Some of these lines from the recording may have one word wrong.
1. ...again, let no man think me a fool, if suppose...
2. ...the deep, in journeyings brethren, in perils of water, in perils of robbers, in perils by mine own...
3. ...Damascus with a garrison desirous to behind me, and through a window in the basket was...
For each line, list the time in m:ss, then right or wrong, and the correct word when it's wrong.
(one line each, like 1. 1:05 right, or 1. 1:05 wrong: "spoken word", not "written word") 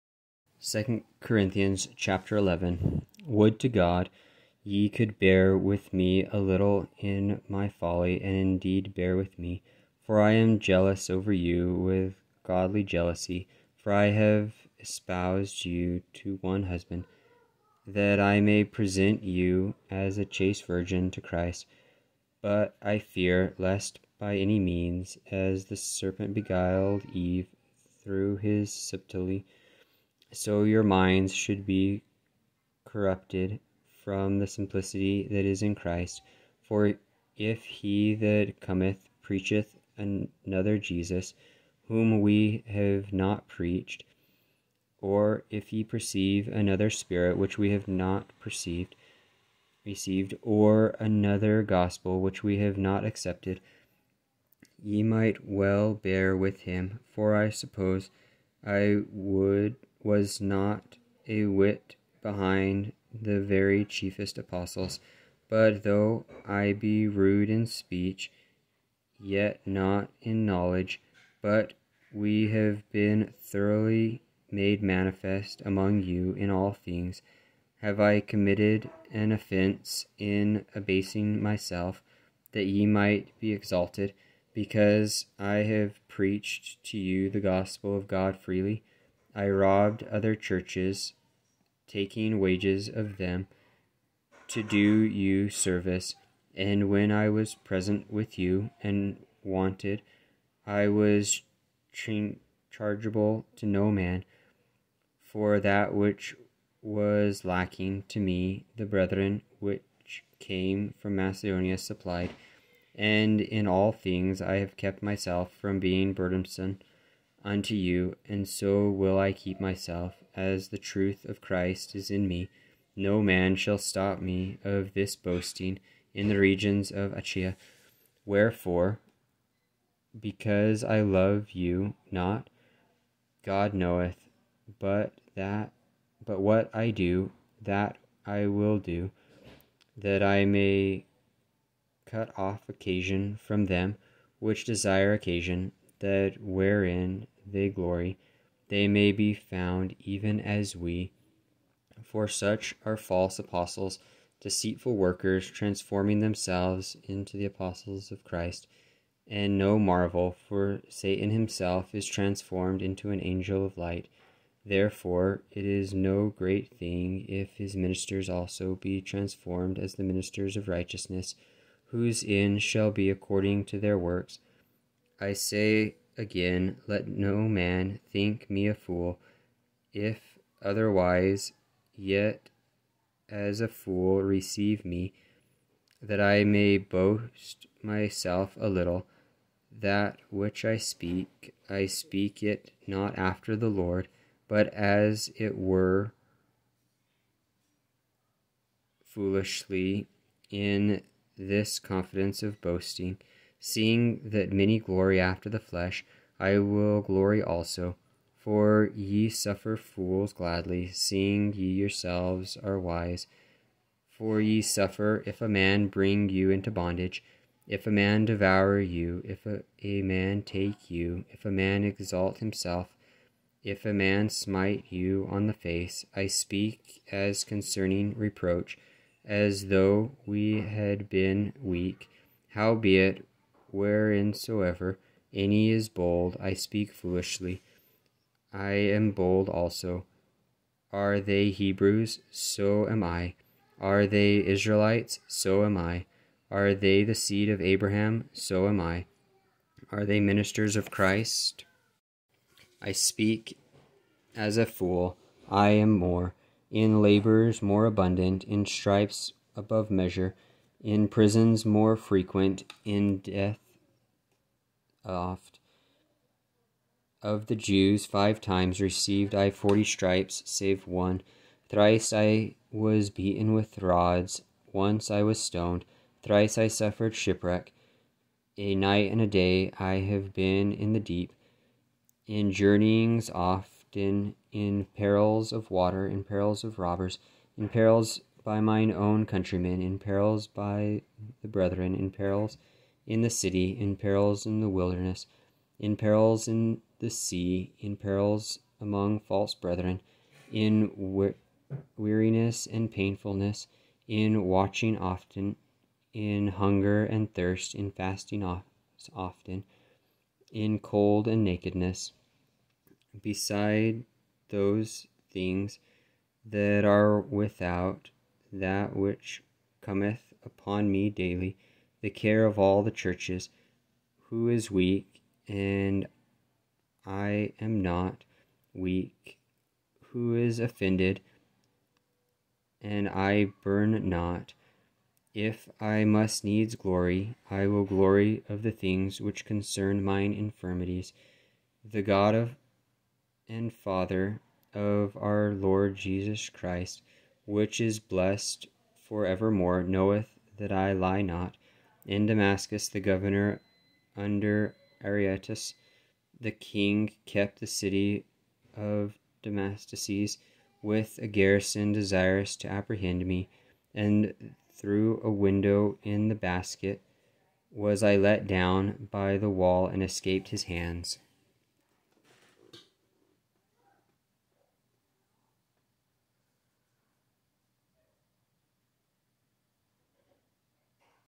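1. 2:56 wrong: "otherwise", not "suppose"
2. 4:40 wrong: "often", not "brethren"
3. 5:59 wrong: "apprehend", not "behind".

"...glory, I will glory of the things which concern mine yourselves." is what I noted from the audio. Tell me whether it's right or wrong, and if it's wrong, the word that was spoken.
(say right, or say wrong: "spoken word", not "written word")
wrong: "infirmities", not "yourselves".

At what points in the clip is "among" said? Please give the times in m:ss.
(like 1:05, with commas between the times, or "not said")
1:15, 4:58.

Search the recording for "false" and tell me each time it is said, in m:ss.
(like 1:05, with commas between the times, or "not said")
2:32, 4:59.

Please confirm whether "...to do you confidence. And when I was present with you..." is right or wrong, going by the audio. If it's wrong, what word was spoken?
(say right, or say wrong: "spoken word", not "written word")
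wrong: "service", not "confidence".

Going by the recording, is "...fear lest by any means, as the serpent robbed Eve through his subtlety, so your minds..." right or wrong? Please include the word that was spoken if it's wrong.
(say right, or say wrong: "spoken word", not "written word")
wrong: "beguiled", not "robbed".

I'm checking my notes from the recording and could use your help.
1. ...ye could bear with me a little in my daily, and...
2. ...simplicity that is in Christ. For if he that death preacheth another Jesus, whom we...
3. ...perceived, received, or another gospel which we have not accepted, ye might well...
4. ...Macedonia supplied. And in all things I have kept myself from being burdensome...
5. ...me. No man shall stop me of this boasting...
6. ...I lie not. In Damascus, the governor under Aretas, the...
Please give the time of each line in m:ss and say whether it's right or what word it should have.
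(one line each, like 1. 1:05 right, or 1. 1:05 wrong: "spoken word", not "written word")
1. 0:04 wrong: "folly", not "daily"
2. 0:34 wrong: "cometh", not "death"
3. 0:48 right
4. 1:51 right
5. 2:02 right
6. 5:50 right.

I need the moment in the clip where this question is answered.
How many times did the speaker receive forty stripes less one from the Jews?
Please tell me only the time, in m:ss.
4:28.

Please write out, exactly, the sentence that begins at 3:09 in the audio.
That which I speak, I speak it not after the Lord, but as it were foolishly, in this confidence of boasting.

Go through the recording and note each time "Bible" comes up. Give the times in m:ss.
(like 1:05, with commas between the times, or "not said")
not said.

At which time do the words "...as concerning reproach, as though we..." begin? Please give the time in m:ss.
3:47.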